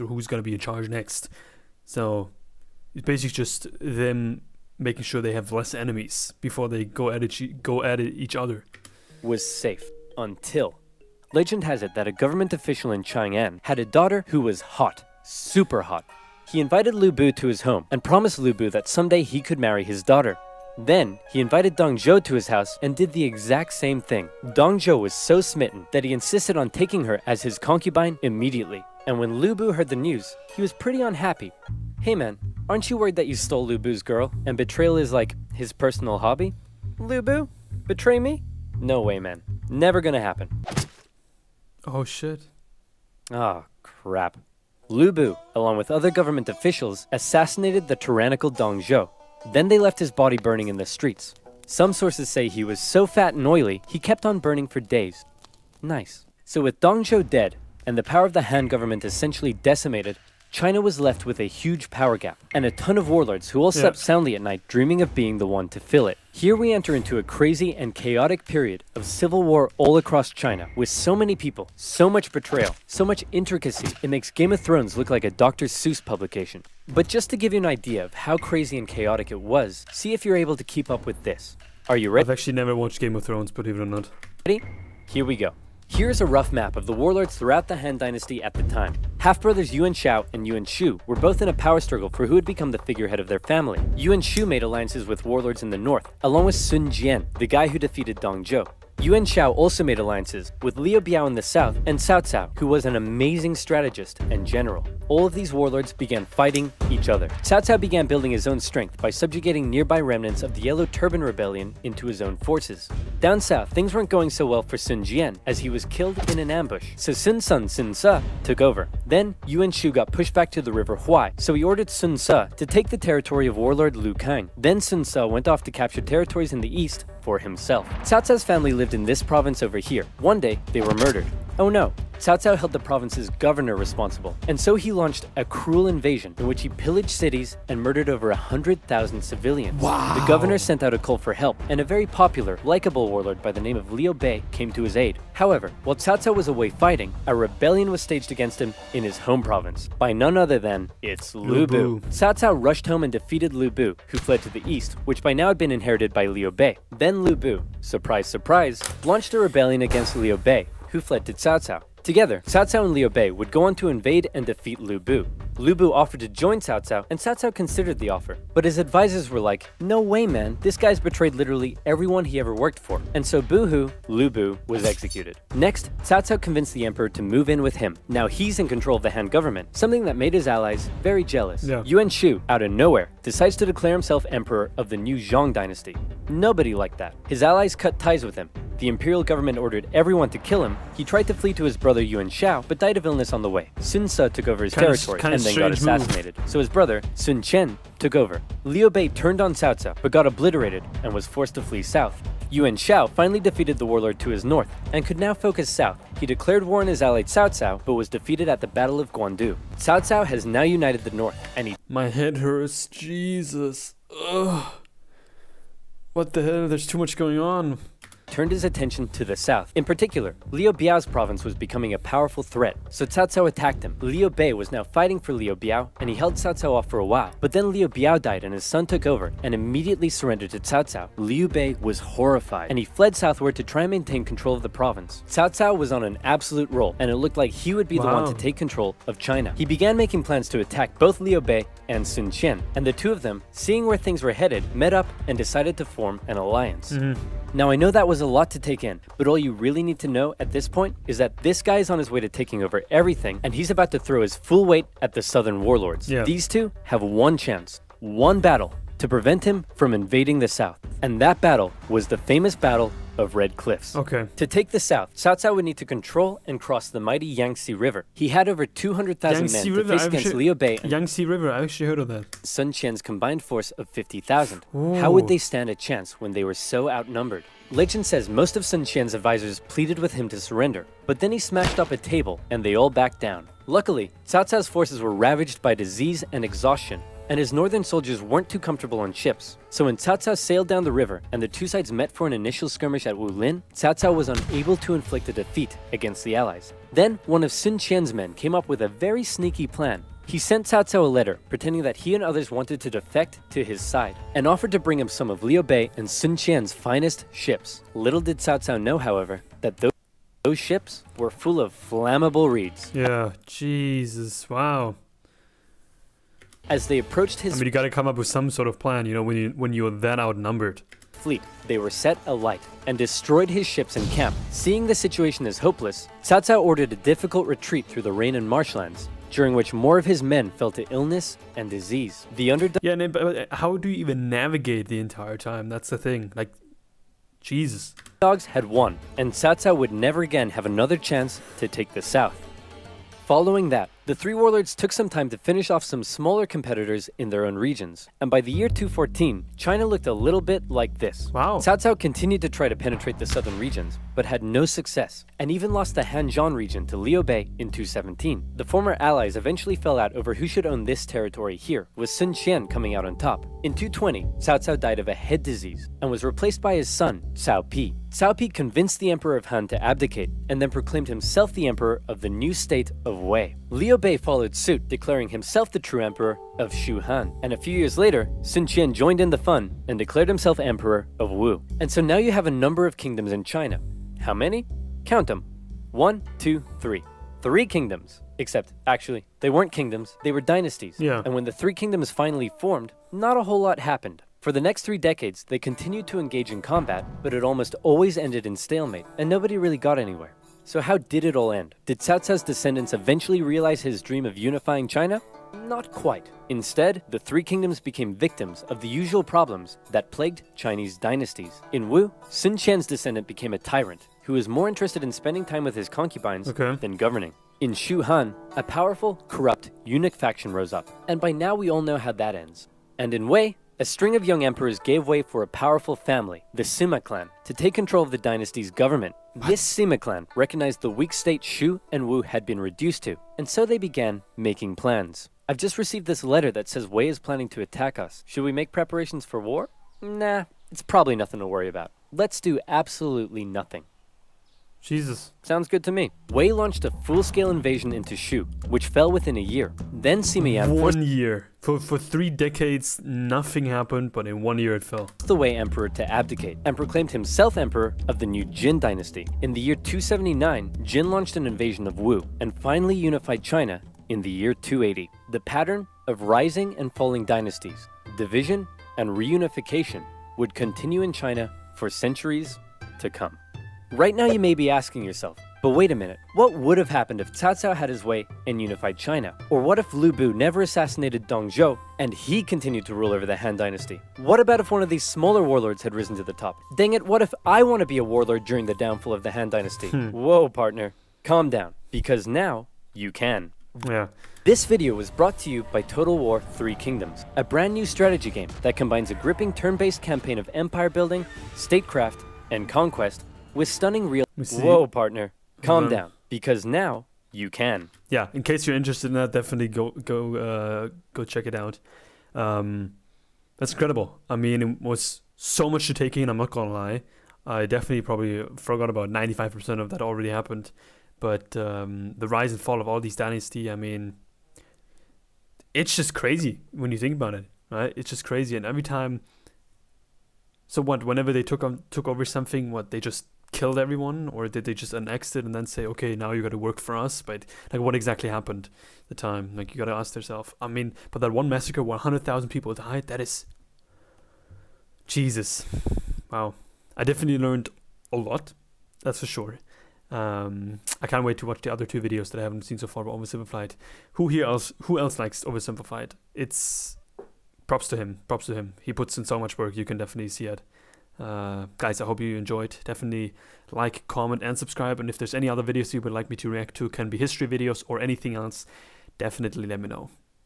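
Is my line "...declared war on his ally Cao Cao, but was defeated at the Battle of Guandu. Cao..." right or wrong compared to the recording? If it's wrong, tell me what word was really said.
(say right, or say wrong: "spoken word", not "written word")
right.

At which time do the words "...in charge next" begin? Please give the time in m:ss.
0:00.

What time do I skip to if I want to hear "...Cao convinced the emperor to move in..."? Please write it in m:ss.
2:56.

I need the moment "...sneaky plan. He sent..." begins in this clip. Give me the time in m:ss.
4:59.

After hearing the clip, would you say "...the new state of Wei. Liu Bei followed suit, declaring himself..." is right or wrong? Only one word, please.
right.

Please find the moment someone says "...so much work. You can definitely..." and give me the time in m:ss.
9:19.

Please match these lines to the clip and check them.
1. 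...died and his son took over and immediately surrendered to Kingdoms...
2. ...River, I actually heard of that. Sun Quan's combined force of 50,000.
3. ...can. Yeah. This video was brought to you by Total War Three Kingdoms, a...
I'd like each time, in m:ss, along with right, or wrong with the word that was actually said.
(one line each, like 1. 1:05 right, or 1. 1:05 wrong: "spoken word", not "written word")
1. 3:48 wrong: "Cao", not "Kingdoms"
2. 4:31 right
3. 8:13 right.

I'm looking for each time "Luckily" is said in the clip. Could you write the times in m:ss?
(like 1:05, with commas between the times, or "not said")
4:43.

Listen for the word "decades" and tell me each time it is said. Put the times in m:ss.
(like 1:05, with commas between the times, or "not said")
6:34, 7:32.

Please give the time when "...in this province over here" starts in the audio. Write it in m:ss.
2:09.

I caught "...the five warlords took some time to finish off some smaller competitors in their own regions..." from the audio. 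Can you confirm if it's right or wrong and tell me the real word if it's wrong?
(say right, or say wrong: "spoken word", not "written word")
wrong: "three", not "five".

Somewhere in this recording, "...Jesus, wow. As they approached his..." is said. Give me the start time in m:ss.
5:13.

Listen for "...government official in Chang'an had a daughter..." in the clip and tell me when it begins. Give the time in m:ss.
0:12.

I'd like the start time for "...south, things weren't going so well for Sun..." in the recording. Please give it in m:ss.
1:53.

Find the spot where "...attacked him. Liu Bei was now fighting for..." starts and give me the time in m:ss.
3:43.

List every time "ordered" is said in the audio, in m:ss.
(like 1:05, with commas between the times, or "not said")
2:01, 3:09, 5:26.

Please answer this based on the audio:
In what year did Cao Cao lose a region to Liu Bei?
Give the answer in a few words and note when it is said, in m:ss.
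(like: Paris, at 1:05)
217, at 5:57.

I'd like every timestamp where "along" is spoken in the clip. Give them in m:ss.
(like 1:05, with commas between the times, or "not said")
0:45, 1:36.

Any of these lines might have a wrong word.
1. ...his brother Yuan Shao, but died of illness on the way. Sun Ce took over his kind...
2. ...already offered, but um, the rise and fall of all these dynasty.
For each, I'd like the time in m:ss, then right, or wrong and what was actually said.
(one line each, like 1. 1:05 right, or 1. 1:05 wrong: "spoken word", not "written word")
1. 3:11 right
2. 8:40 wrong: "happened", not "offered".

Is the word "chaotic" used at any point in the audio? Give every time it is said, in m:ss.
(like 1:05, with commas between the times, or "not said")
1:07, 1:18.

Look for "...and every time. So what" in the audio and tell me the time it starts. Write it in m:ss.
8:48.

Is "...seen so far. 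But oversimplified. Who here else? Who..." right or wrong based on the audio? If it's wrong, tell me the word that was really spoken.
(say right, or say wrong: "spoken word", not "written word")
right.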